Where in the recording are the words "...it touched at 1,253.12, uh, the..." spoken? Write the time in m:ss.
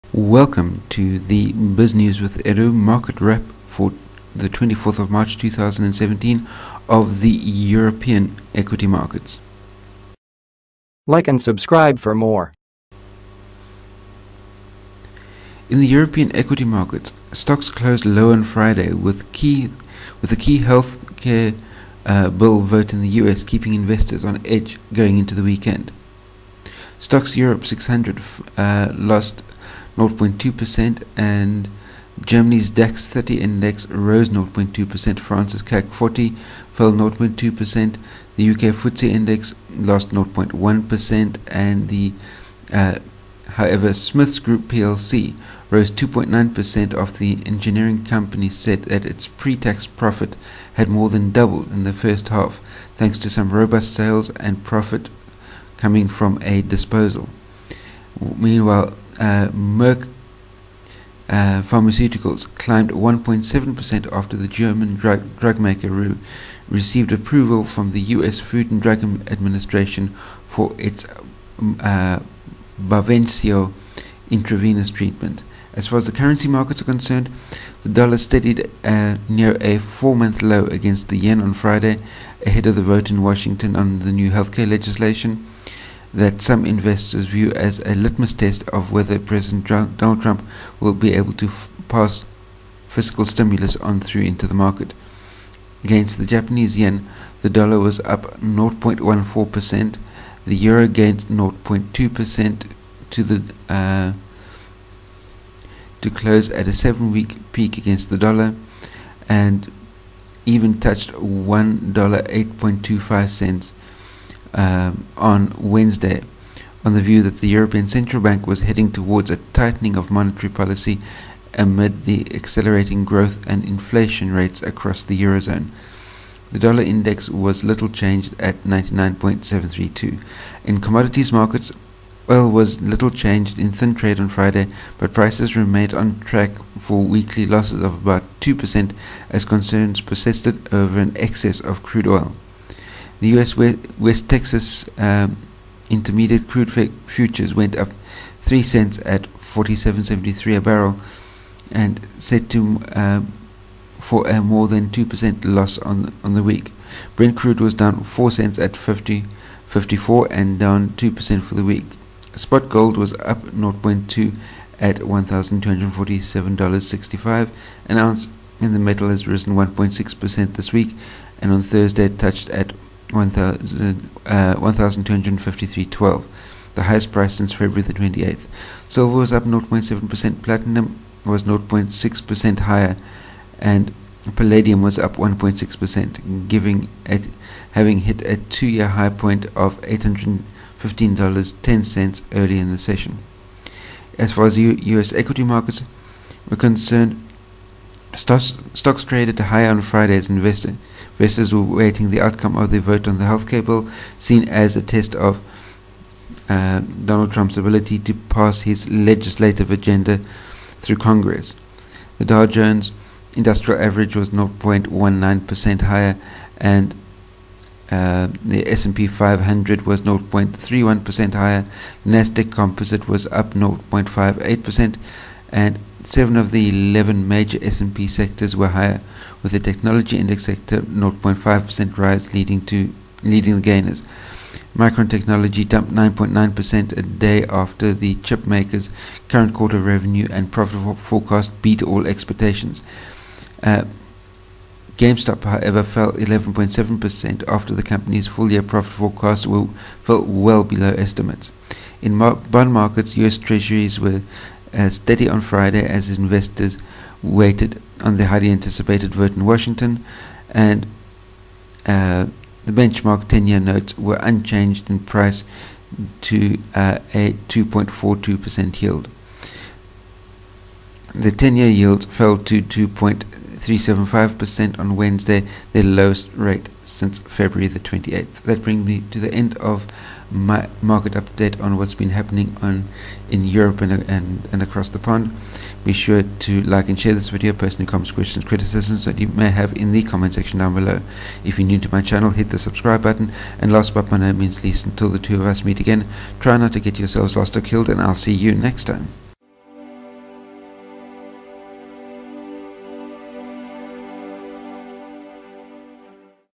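2:52.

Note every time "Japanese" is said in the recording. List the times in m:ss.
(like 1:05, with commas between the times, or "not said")
1:36.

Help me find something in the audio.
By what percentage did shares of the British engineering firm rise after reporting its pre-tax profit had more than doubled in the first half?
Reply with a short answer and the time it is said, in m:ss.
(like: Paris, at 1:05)
2.9%, at 0:45.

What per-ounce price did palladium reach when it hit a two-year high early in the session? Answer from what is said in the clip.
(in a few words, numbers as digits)
$815.10.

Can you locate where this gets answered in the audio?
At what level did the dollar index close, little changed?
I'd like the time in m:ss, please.
2:08.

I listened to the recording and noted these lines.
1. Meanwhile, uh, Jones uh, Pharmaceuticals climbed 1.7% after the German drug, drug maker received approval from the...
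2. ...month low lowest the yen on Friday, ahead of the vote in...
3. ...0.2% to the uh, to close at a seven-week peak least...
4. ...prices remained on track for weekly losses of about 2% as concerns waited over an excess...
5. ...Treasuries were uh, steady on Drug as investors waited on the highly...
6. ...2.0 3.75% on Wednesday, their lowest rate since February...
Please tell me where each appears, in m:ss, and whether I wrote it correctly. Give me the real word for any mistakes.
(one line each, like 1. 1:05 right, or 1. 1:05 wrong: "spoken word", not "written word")
1. 0:58 wrong: "Merck", not "Jones"
2. 1:20 wrong: "against", not "lowest"
3. 1:41 wrong: "against", not "least"
4. 2:15 wrong: "persisted", not "waited"
5. 4:13 wrong: "Friday", not "Drug"
6. 4:32 right.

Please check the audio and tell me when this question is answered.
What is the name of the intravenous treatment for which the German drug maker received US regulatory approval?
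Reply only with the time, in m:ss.
1:12.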